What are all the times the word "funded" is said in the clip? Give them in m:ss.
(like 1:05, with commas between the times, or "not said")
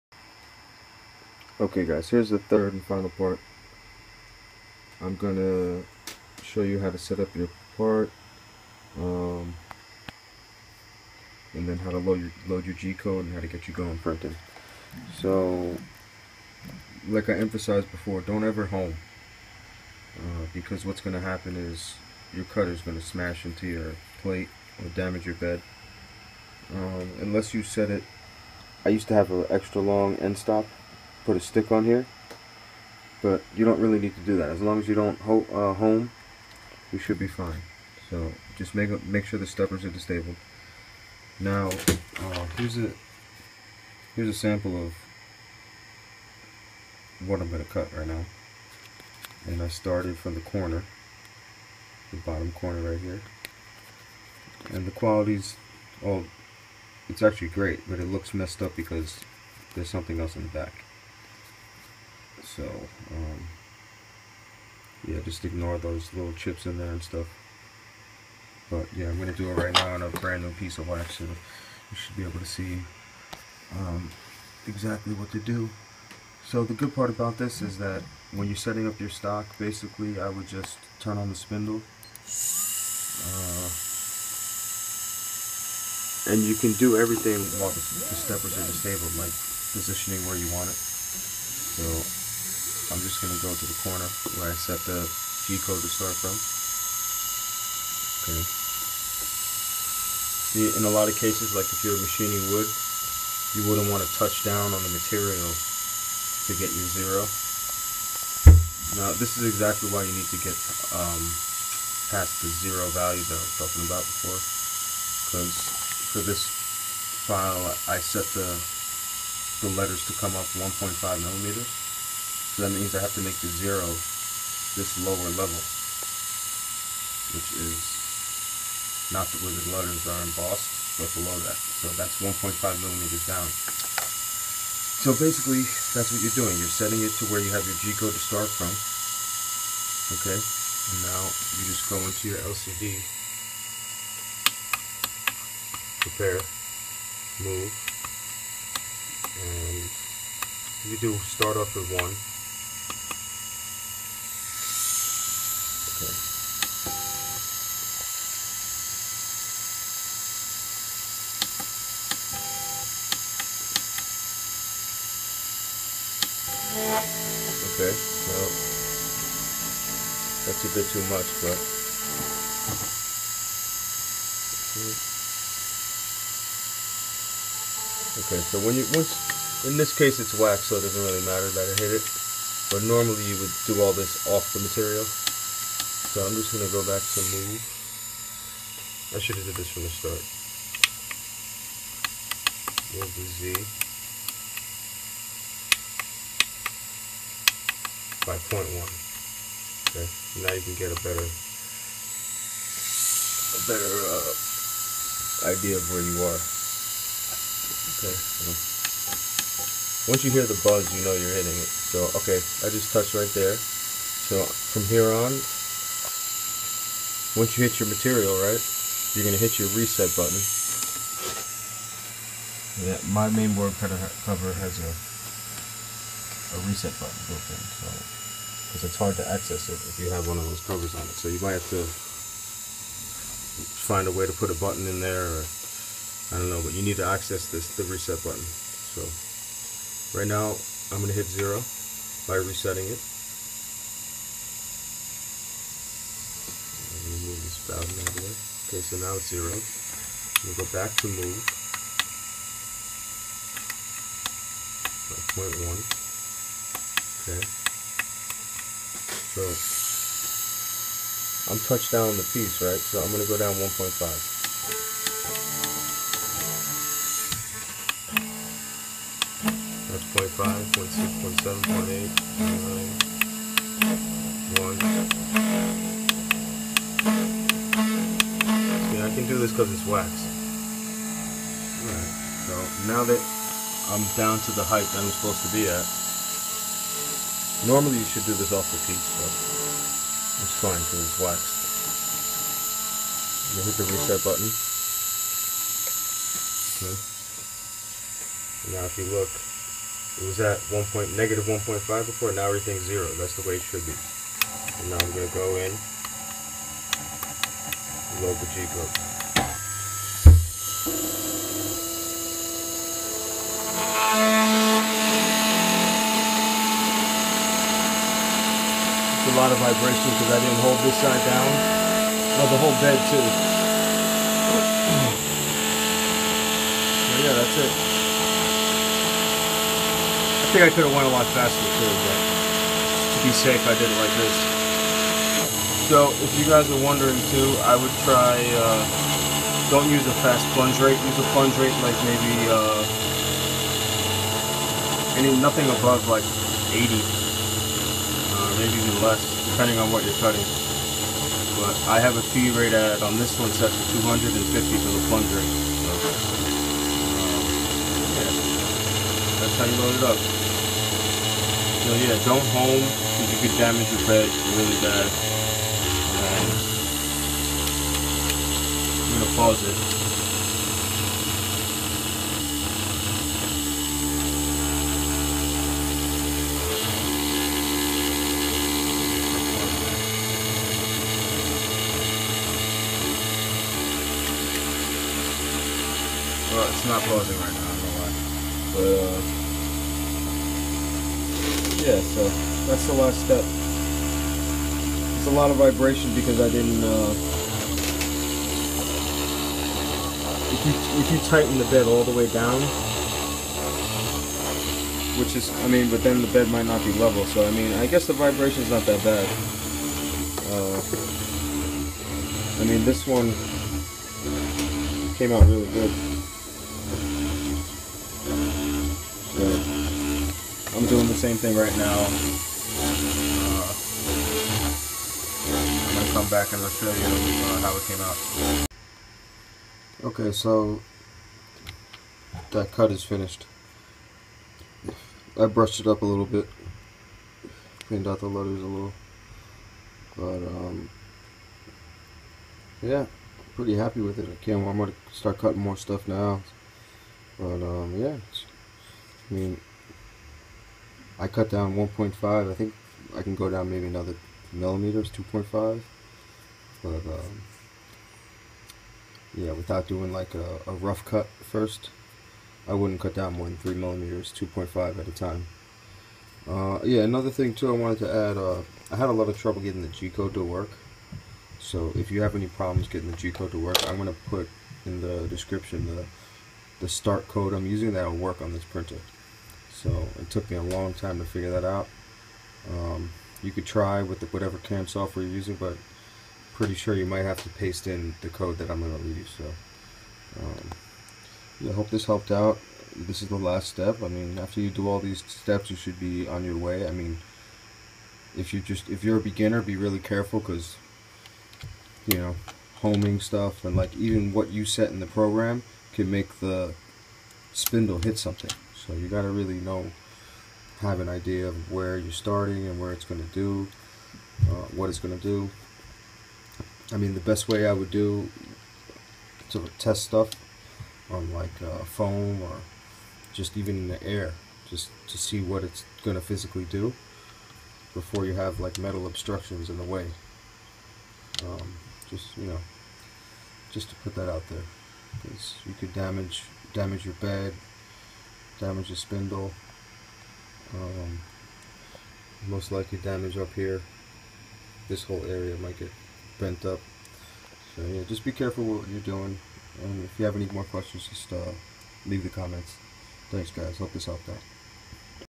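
not said.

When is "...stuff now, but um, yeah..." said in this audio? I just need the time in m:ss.
7:25.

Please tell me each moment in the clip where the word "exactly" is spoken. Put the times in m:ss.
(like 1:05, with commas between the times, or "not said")
1:14, 1:49.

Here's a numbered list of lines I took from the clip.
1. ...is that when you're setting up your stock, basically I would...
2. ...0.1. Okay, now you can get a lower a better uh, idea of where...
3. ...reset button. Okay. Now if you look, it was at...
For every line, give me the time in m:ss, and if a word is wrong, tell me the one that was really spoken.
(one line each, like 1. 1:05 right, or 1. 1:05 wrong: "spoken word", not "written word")
1. 1:17 right
2. 3:18 wrong: "better", not "lower"
3. 4:53 right.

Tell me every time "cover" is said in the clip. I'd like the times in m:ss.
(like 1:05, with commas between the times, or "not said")
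3:44, 3:50.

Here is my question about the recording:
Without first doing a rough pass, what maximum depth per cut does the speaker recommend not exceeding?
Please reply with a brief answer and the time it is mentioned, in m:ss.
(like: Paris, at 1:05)
3 millimeters, at 7:43.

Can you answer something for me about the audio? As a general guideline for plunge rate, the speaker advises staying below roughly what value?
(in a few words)
80.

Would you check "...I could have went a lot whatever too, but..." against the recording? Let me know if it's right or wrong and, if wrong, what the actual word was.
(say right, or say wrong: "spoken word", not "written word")
wrong: "faster", not "whatever".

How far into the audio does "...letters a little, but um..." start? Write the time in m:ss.
7:18.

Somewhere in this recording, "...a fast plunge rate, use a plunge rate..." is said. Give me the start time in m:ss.
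5:40.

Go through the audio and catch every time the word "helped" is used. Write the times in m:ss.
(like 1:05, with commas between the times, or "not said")
8:12, 9:14.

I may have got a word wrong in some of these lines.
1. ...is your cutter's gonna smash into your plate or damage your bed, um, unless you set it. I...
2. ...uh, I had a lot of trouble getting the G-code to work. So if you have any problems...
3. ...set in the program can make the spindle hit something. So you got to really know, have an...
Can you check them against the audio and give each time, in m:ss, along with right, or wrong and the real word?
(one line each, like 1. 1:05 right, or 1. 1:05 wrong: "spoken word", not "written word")
1. 0:21 right
2. 7:48 right
3. 8:24 right.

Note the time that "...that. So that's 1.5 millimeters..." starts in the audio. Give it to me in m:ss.
2:11.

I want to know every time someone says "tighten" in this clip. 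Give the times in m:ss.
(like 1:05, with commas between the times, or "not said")
6:41.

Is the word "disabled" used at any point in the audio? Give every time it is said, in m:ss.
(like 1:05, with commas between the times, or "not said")
0:39, 1:28.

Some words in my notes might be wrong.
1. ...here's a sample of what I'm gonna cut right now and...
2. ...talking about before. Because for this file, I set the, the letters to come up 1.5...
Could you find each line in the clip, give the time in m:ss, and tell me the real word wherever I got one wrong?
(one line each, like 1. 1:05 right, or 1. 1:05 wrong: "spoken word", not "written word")
1. 0:44 right
2. 1:53 right.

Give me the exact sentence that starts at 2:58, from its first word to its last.
Okay, so when you once in this case it's wax, so it doesn't really matter that I hit it.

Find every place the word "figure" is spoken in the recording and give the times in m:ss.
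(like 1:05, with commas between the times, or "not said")
8:01.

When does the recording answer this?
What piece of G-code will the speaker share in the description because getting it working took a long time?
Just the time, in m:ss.
7:56.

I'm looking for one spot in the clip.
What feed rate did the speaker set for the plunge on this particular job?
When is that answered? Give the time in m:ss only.
5:53.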